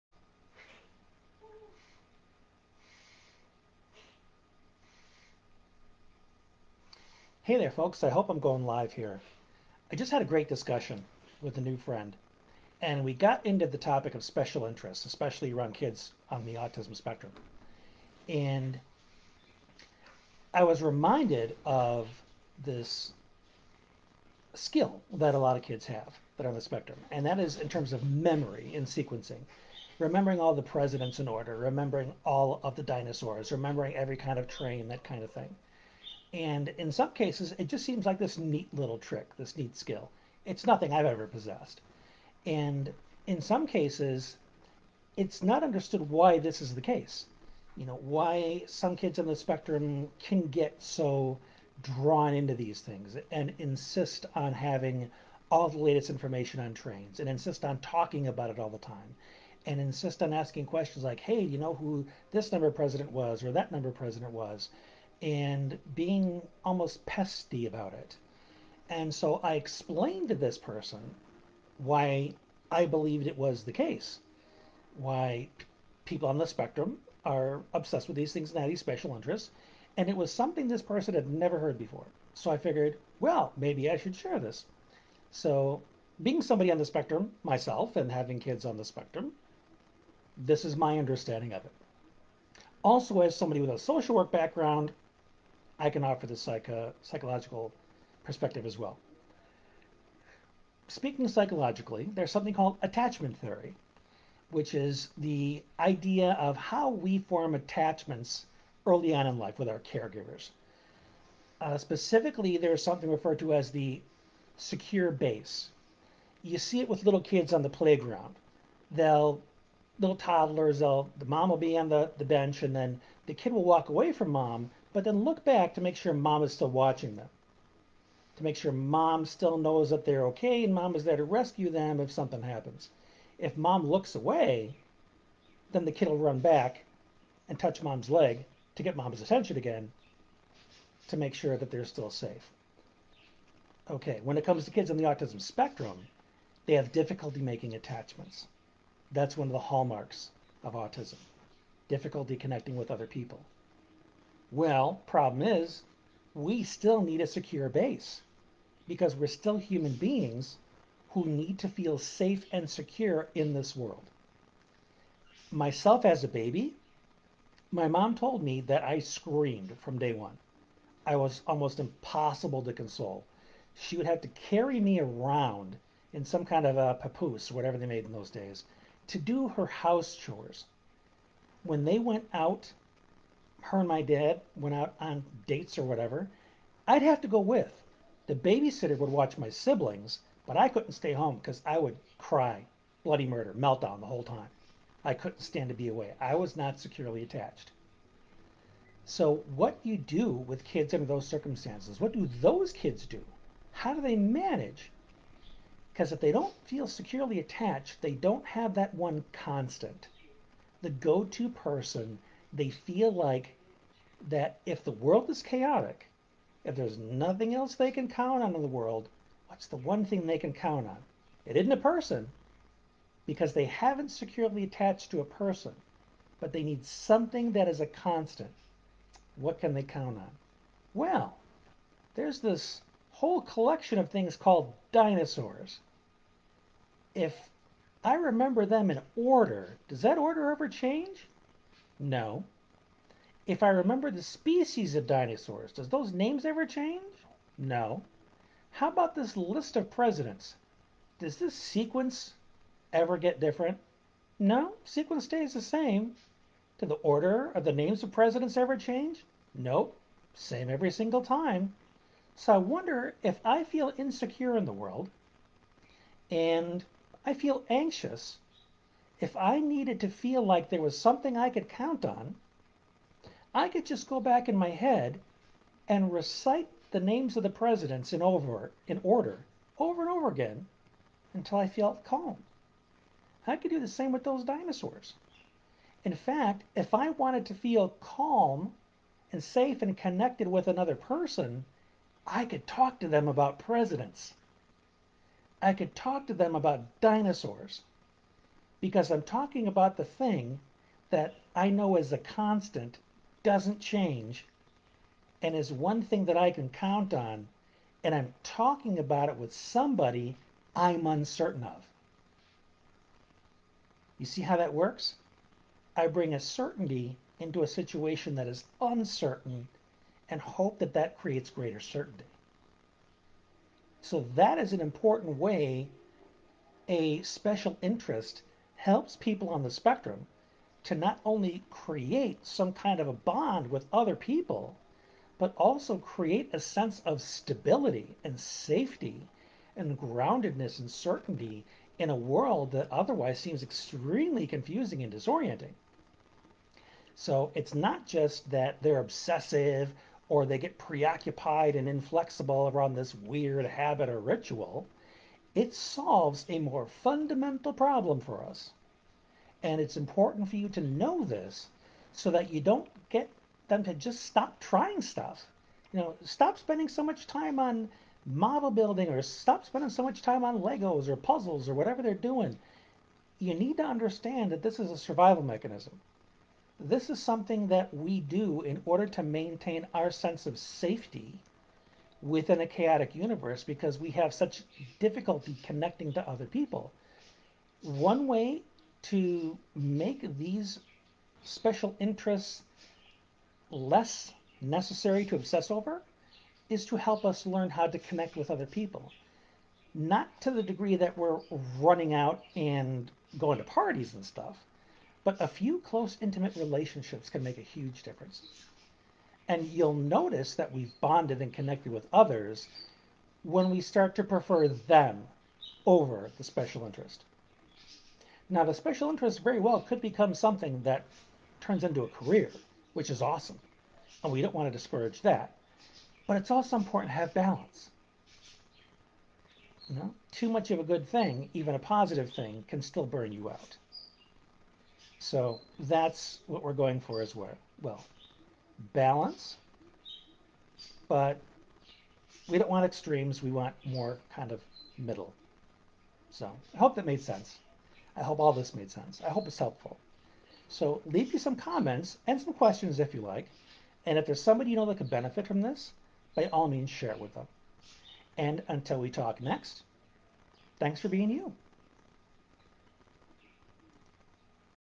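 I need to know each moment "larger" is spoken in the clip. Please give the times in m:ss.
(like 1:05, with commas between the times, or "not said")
not said.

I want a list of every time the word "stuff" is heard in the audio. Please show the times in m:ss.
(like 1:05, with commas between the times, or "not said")
6:05, 6:44.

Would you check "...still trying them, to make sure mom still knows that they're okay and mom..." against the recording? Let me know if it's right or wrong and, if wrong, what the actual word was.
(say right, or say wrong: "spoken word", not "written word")
wrong: "watching", not "trying".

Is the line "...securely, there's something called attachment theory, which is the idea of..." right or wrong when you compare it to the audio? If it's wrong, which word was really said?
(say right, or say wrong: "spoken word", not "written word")
wrong: "psychologically", not "securely".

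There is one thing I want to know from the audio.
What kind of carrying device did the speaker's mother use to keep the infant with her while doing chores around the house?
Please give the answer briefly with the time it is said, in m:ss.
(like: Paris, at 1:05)
papoose, at 2:56.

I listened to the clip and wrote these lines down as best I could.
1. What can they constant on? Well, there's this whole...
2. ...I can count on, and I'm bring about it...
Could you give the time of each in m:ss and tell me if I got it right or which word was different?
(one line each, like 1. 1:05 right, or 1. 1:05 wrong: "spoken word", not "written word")
1. 3:49 wrong: "count", not "constant"
2. 5:06 wrong: "talking", not "bring".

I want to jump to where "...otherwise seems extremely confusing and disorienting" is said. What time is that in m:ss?
5:42.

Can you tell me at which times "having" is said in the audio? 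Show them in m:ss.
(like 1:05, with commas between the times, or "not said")
0:54, 1:28.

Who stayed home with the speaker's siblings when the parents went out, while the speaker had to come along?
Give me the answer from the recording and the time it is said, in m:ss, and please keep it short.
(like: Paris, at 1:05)
The babysitter, at 3:08.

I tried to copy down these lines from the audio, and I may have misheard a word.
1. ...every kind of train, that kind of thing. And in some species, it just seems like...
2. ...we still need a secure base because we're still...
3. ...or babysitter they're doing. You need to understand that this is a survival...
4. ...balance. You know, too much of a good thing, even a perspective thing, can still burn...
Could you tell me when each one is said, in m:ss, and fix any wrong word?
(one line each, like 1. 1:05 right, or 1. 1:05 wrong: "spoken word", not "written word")
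1. 0:33 wrong: "cases", not "species"
2. 2:36 right
3. 6:11 wrong: "whatever", not "babysitter"
4. 7:07 wrong: "positive", not "perspective".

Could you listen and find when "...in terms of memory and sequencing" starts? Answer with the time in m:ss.
0:27.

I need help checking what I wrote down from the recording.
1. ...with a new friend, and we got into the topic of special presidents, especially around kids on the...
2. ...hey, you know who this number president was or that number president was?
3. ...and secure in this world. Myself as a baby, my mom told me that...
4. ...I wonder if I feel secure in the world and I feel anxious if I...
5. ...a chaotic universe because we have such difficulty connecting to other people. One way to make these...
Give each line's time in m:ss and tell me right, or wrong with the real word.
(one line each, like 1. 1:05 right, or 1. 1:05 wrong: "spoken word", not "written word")
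1. 0:11 wrong: "interests", not "presidents"
2. 1:01 right
3. 2:42 right
4. 4:22 wrong: "insecure", not "secure"
5. 6:22 right.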